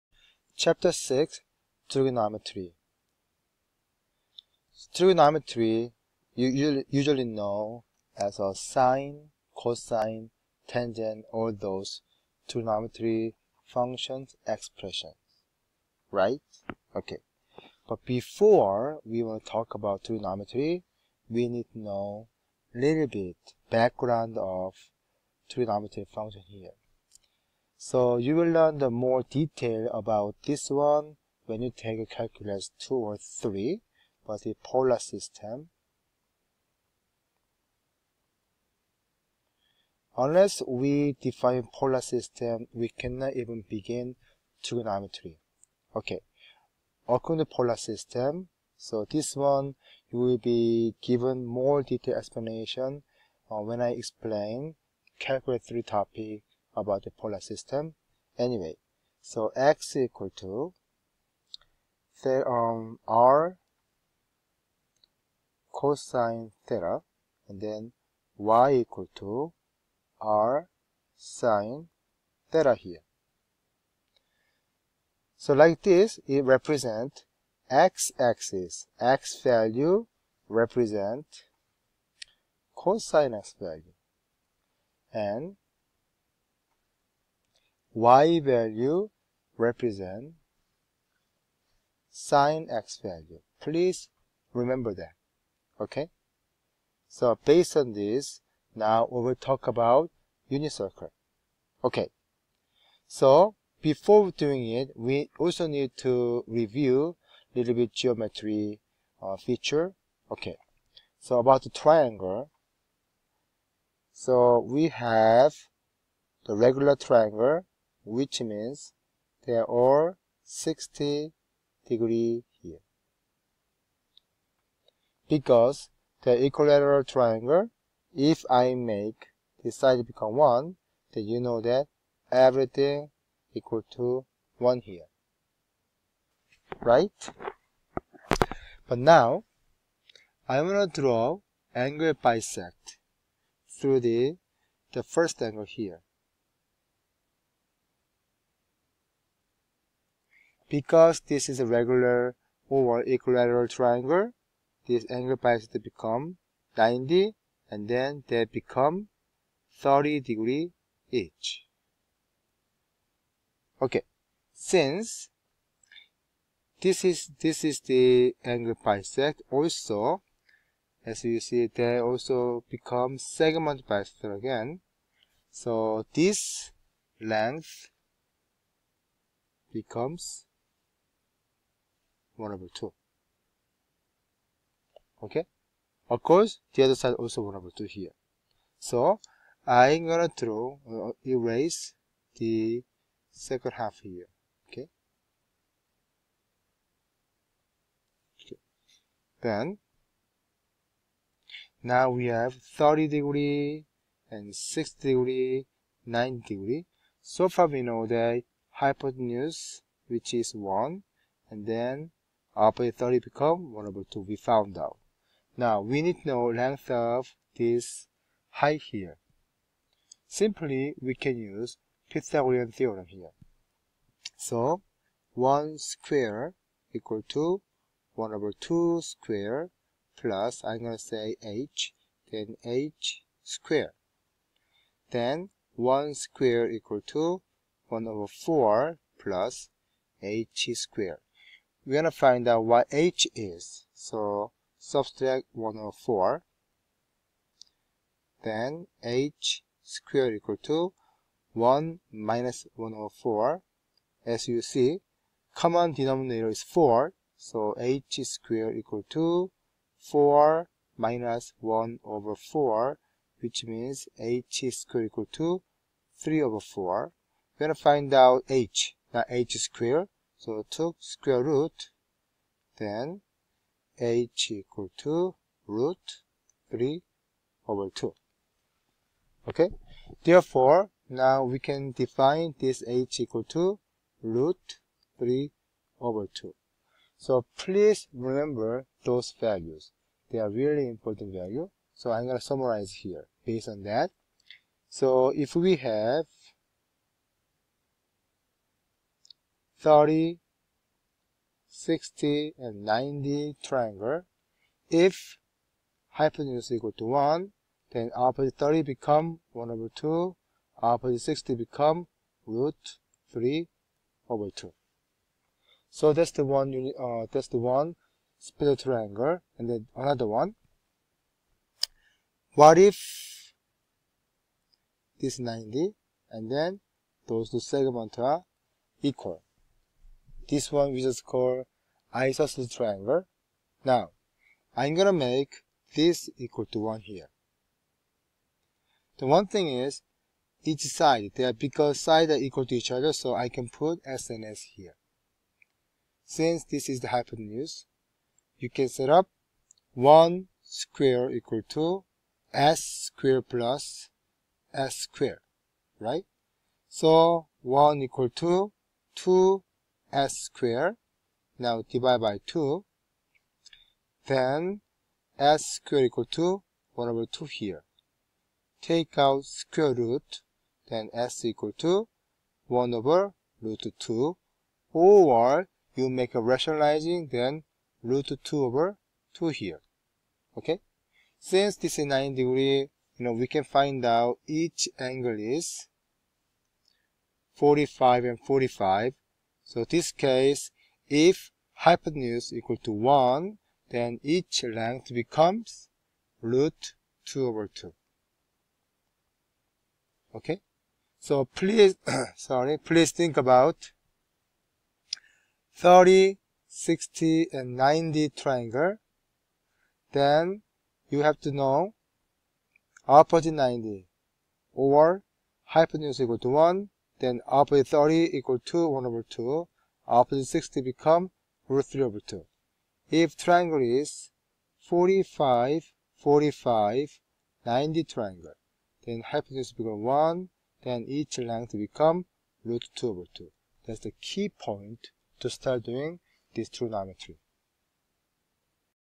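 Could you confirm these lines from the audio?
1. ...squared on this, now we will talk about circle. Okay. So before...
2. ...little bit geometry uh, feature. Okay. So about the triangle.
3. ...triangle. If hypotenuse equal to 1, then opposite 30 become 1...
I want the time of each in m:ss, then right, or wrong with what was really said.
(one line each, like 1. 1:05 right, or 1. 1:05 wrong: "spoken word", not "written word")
1. 1:37 wrong: "based", not "squared"
2. 1:47 right
3. 5:03 right.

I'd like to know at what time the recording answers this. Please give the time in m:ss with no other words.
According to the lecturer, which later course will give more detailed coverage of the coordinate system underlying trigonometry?
0:55.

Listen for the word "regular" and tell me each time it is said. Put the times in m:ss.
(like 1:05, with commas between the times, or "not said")
1:56, 2:31.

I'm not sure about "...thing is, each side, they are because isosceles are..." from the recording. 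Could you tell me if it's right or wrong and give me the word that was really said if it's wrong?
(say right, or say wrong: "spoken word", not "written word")
wrong: "sides", not "isosceles".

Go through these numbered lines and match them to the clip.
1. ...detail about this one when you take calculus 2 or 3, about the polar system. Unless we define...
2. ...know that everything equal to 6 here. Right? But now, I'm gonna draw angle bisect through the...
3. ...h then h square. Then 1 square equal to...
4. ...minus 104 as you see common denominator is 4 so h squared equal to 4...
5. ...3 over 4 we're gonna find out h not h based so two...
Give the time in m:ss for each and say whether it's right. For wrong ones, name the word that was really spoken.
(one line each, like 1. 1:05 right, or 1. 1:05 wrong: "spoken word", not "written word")
1. 0:29 right
2. 2:11 wrong: "1", not "6"
3. 3:51 right
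4. 4:12 right
5. 4:26 wrong: "squared", not "based".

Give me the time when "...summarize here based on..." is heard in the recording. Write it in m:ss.
4:52.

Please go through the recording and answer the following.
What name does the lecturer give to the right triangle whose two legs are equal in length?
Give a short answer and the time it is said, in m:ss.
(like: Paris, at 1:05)
isosceles triangle, at 5:32.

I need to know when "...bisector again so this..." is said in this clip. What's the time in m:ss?
2:53.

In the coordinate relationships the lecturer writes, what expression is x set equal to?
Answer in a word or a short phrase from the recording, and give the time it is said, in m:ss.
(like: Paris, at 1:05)
r cosine theta, at 1:03.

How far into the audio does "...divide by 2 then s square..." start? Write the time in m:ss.
6:01.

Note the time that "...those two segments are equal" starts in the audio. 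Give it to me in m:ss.
5:27.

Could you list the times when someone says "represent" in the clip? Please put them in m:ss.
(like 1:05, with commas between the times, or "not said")
1:16, 1:20, 1:29.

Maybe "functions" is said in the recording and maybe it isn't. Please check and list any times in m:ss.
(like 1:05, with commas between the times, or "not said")
0:13, 0:26.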